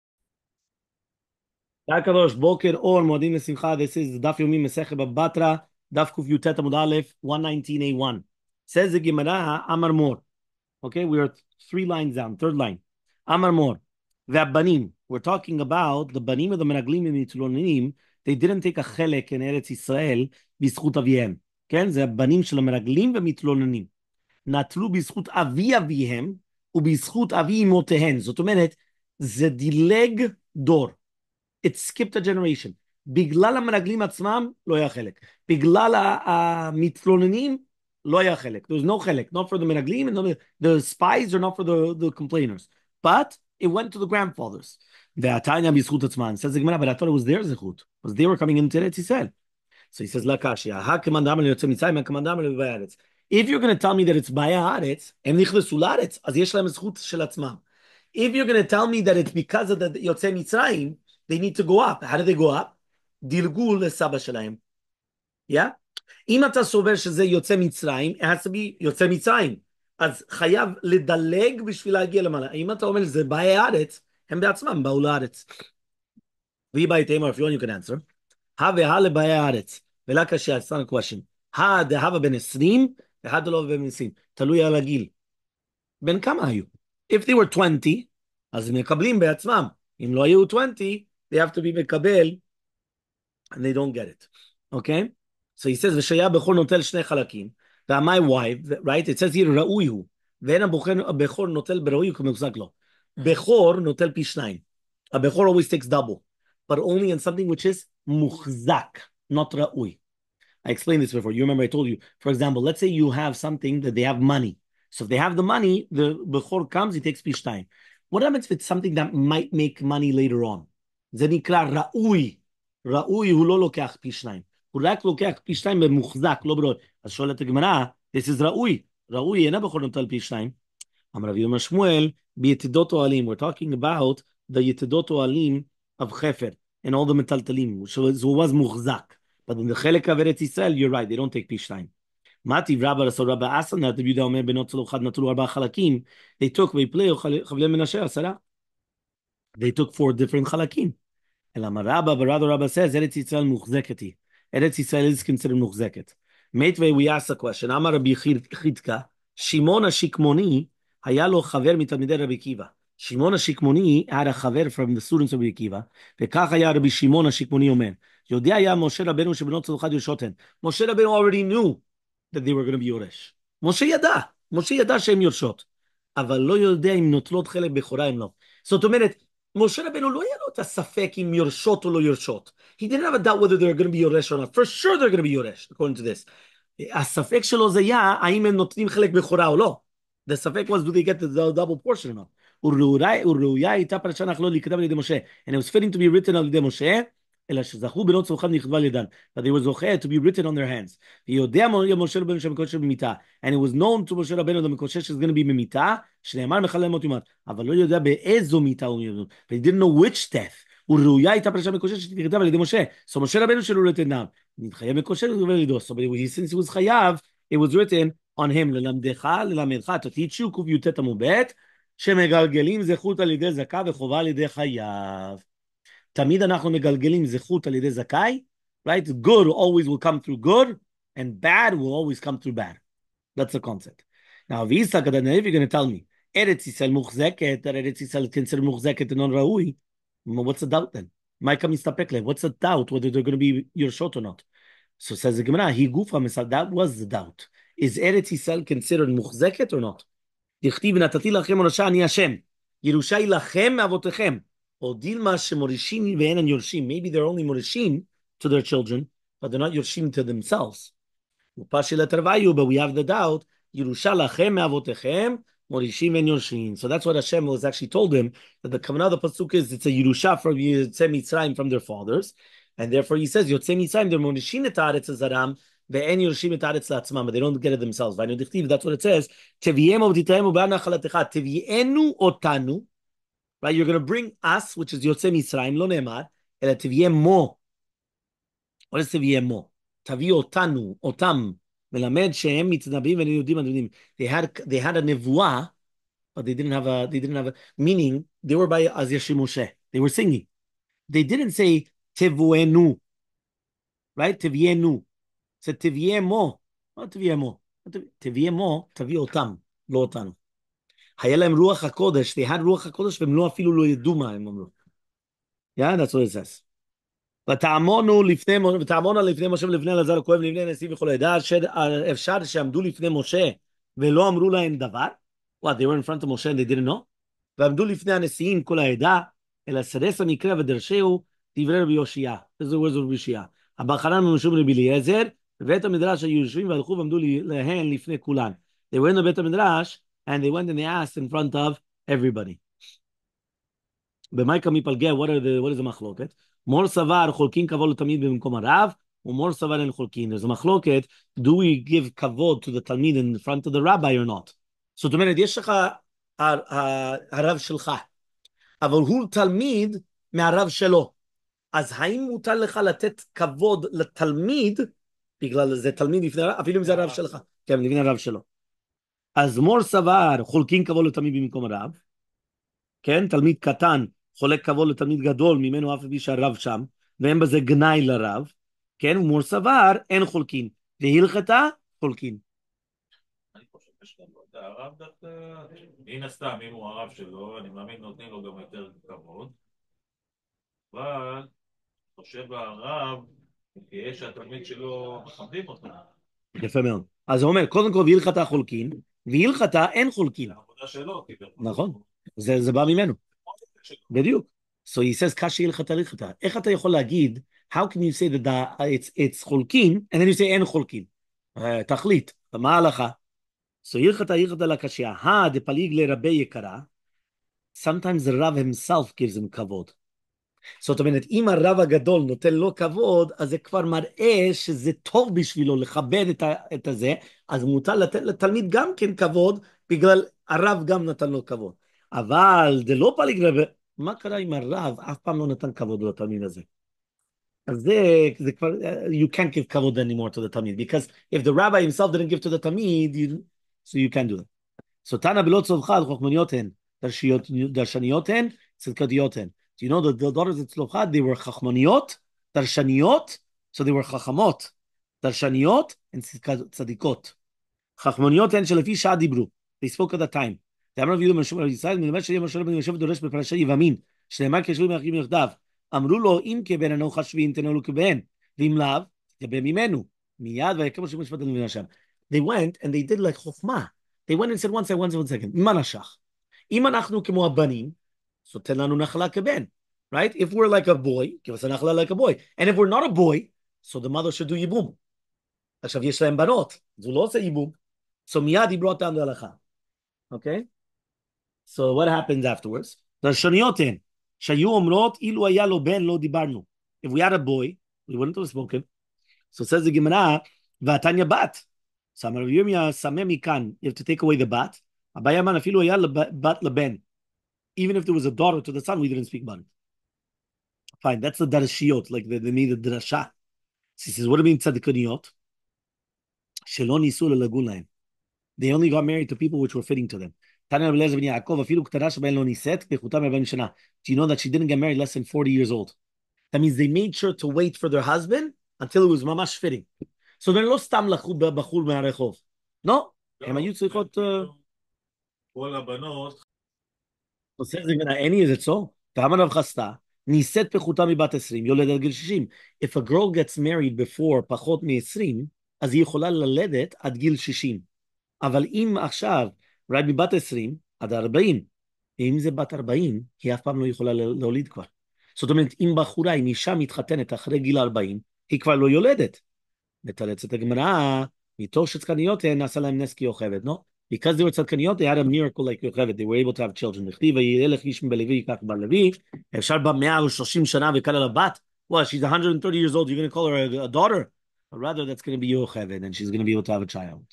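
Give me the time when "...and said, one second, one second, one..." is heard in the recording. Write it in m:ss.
7:54.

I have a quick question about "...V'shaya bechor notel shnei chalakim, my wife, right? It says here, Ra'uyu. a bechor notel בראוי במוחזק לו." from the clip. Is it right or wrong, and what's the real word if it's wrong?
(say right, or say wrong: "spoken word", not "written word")
wrong: "כמוחזק", not "במוחזק".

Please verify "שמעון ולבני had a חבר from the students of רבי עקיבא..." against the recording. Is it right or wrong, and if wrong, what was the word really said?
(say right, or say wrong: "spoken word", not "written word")
wrong: "השקמוני", not "ולבני".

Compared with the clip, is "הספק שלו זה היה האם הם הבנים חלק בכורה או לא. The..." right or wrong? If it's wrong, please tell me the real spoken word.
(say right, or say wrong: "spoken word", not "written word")
wrong: "נותנים", not "הבנים".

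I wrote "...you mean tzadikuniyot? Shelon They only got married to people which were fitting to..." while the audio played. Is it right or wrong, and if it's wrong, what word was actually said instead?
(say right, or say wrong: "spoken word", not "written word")
right.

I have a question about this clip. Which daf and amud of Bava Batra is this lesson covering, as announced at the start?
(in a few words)
119A.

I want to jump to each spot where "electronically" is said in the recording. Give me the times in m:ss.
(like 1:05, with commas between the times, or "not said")
not said.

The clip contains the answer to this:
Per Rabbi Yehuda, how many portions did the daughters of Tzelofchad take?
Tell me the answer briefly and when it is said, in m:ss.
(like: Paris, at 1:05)
4, at 2:25.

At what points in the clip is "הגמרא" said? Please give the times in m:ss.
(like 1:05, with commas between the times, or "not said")
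2:07, 9:20.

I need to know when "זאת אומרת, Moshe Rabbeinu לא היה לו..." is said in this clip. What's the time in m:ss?
2:58.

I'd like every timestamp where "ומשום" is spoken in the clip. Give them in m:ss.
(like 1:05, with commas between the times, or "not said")
5:34.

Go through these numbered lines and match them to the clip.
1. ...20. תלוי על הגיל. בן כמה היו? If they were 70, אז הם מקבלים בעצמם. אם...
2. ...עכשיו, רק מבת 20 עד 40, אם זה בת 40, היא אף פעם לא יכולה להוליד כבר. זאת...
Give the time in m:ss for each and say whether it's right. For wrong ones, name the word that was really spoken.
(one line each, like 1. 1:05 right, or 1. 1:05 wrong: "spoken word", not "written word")
1. 1:23 wrong: "20", not "70"
2. 9:09 right.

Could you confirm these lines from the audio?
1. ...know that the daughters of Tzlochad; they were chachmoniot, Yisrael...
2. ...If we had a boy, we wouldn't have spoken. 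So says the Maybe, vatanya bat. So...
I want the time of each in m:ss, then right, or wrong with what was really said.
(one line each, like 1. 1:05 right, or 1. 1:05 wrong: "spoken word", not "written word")
1. 7:29 wrong: "Darshaniot", not "Yisrael"
2. 8:17 wrong: "Gemara", not "Maybe".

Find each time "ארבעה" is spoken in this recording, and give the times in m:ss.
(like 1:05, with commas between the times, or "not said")
2:25.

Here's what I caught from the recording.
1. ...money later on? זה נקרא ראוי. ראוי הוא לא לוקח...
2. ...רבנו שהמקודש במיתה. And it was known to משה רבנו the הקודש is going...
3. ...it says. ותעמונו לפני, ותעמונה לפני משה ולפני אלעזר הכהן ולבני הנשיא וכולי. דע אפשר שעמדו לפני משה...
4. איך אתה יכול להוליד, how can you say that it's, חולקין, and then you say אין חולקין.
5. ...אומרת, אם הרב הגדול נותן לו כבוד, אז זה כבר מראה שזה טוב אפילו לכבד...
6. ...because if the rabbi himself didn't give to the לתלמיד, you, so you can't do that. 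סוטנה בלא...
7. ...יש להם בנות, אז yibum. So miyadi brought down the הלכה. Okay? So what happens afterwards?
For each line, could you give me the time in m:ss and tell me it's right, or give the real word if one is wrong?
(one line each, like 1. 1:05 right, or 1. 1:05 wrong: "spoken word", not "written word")
1. 1:59 right
2. 3:22 wrong: "מקודש", not "הקודש"
3. 5:16 right
4. 6:46 wrong: "להגיד", not "להוליד"
5. 7:00 wrong: "בשבילו", not "אפילו"
6. 7:20 wrong: "תלמיד", not "לתלמיד"
7. 8:06 right.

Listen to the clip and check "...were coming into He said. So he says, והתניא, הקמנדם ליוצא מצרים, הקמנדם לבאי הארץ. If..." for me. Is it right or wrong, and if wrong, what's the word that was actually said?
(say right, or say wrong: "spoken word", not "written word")
wrong: "לקשיא", not "והתניא".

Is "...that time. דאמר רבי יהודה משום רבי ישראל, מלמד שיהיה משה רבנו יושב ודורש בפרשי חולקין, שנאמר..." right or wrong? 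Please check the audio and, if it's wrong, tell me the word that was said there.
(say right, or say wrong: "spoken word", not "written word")
wrong: "יבמין", not "חולקין".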